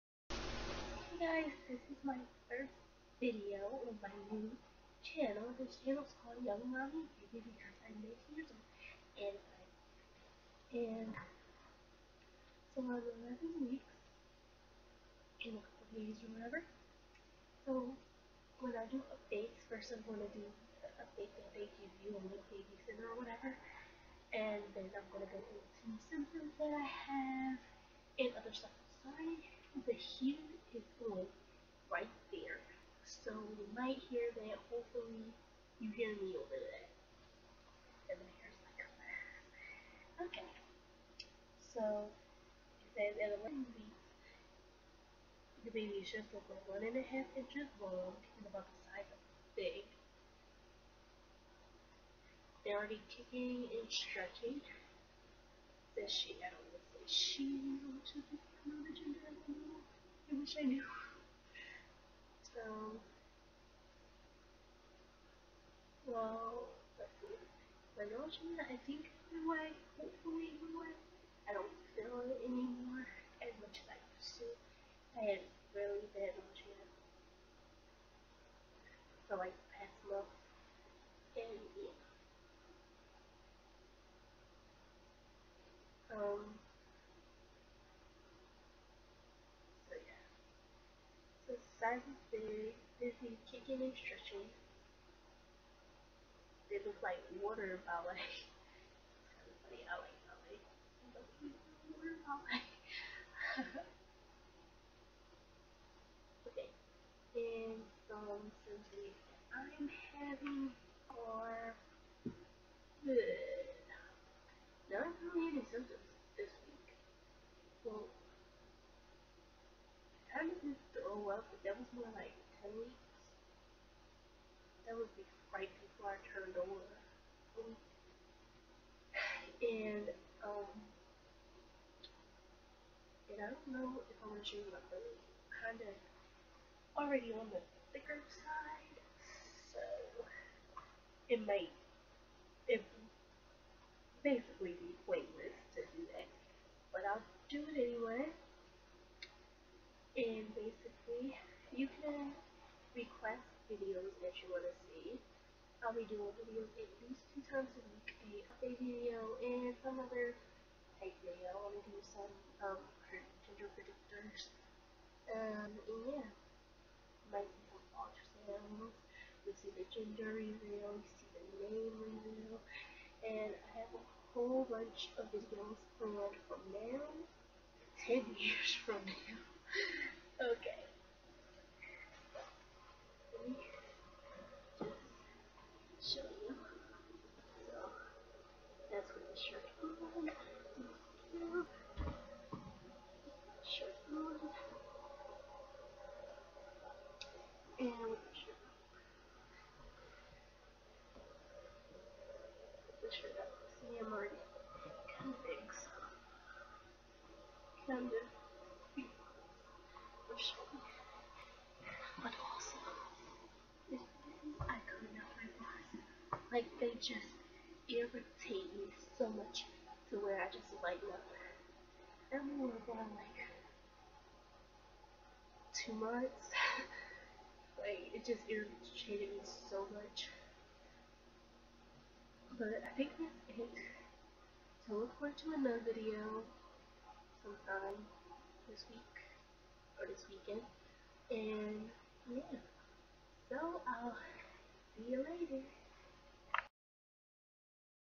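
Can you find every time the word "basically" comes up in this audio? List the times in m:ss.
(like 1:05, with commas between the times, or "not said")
2:24, 2:30.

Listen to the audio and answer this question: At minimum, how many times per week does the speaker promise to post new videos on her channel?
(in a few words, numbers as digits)
2.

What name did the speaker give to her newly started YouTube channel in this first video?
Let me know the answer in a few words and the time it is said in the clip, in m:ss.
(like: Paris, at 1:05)
Young Mommy Baby, at 0:06.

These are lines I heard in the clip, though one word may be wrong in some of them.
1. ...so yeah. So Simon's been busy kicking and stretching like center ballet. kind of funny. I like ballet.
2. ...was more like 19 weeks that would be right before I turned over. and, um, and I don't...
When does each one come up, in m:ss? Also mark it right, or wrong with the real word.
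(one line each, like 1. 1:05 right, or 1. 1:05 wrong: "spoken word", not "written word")
1. 1:26 wrong: "water", not "center"
2. 2:01 wrong: "10", not "19".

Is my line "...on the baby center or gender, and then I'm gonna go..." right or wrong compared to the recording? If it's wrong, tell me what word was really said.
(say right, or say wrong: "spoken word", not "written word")
wrong: "whatever", not "gender".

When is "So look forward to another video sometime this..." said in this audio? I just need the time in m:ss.
3:54.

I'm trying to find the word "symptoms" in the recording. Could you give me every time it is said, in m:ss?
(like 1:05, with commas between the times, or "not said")
0:26, 1:55.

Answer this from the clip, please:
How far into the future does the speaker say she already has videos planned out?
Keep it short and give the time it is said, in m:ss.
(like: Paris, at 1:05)
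10 years, at 2:58.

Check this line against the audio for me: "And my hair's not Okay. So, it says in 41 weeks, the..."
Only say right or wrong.
wrong.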